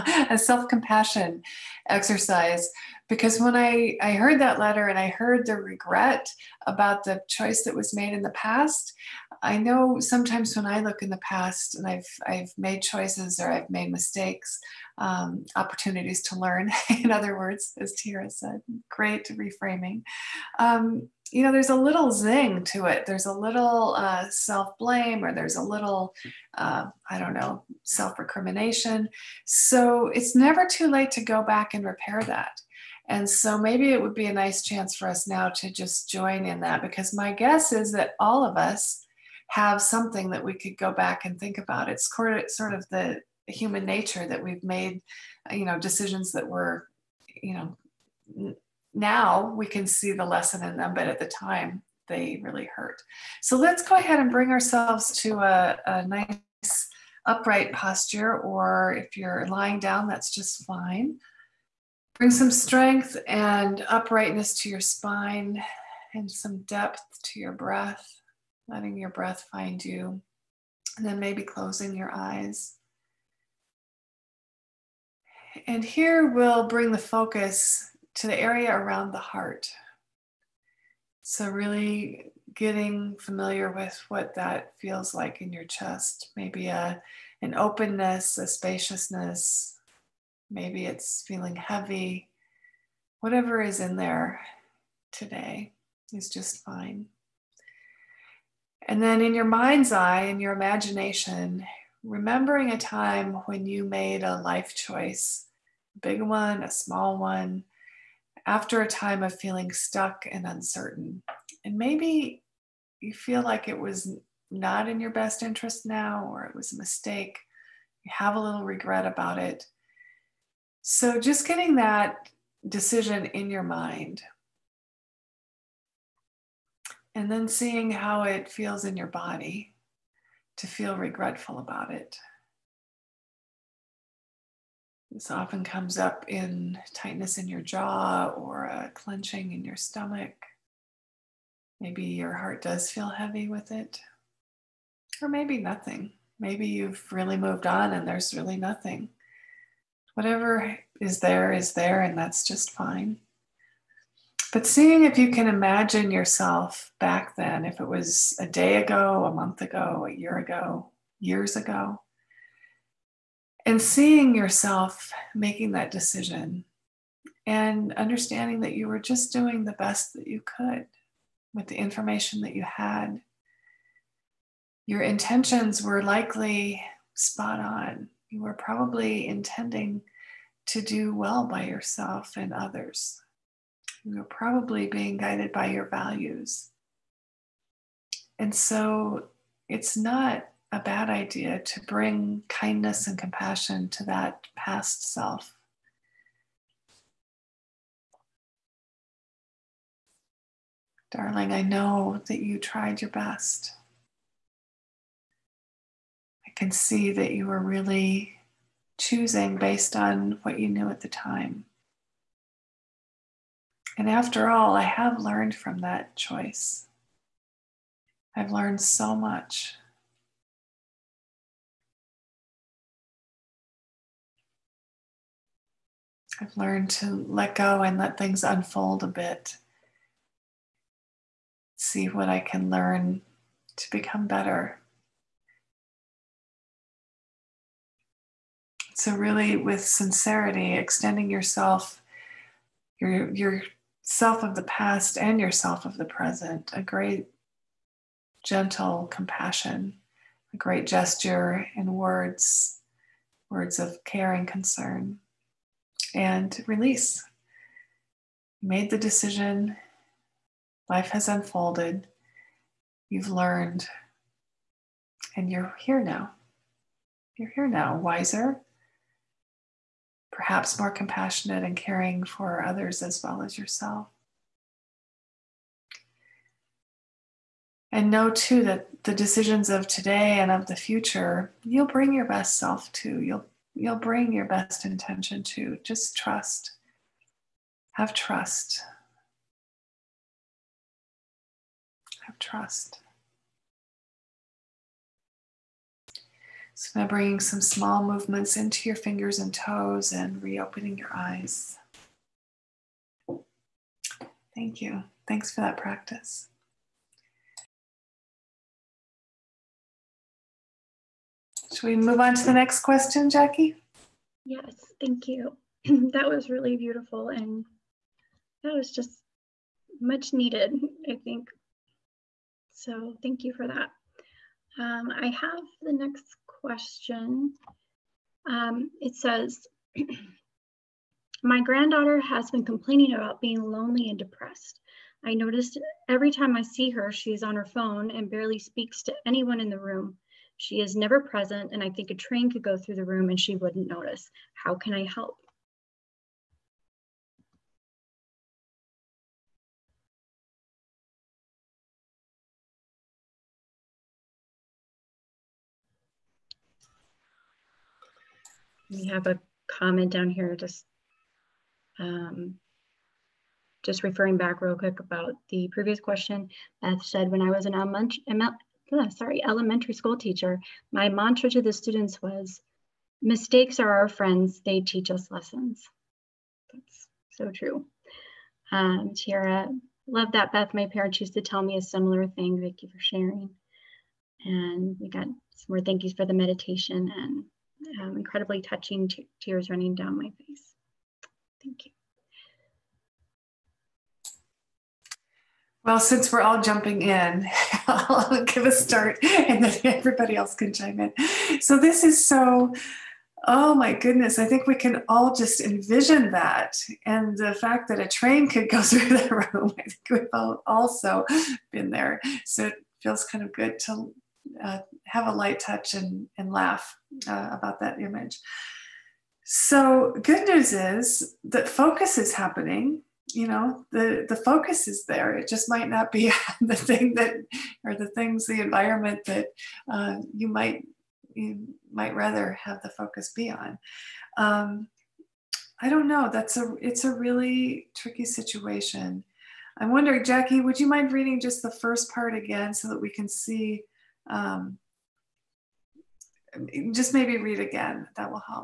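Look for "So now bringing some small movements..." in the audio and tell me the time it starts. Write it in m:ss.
4:56.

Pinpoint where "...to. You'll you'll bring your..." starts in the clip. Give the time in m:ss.
4:42.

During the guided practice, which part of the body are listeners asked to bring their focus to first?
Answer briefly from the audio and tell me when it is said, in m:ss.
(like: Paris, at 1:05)
the area around the heart, at 1:18.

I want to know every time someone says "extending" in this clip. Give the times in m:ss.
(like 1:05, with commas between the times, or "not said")
4:00.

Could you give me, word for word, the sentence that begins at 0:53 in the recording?
So let's go ahead and bring ourselves to a, a nice upright posture, or if you're lying down, that's just fine.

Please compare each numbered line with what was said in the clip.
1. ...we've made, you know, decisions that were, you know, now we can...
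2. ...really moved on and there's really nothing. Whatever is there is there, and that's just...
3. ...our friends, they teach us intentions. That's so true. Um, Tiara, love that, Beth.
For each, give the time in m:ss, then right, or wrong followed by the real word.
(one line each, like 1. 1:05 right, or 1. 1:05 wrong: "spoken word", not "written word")
1. 0:44 right
2. 2:27 right
3. 6:13 wrong: "lessons", not "intentions".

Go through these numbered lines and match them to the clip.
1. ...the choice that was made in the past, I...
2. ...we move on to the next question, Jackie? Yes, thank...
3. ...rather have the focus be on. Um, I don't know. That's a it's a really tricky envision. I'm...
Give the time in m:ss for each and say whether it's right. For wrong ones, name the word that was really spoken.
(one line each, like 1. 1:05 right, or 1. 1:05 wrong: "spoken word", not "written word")
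1. 0:07 right
2. 5:11 right
3. 7:12 wrong: "situation", not "envision".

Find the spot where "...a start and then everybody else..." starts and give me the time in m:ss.
6:38.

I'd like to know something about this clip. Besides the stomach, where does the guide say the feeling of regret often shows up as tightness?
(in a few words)
jaw.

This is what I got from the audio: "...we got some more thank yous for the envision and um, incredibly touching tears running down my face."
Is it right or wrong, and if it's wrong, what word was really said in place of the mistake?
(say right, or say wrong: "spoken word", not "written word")
wrong: "meditation", not "envision".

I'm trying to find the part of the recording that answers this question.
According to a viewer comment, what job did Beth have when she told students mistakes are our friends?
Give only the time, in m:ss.
6:09.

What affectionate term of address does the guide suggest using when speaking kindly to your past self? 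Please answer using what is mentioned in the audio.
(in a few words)
Darling.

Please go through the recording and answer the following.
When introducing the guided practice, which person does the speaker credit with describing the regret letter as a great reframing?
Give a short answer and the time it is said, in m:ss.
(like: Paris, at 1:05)
Tira, at 0:17.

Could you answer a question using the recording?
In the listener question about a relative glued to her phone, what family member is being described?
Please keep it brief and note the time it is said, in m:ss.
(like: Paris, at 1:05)
granddaughter, at 5:31.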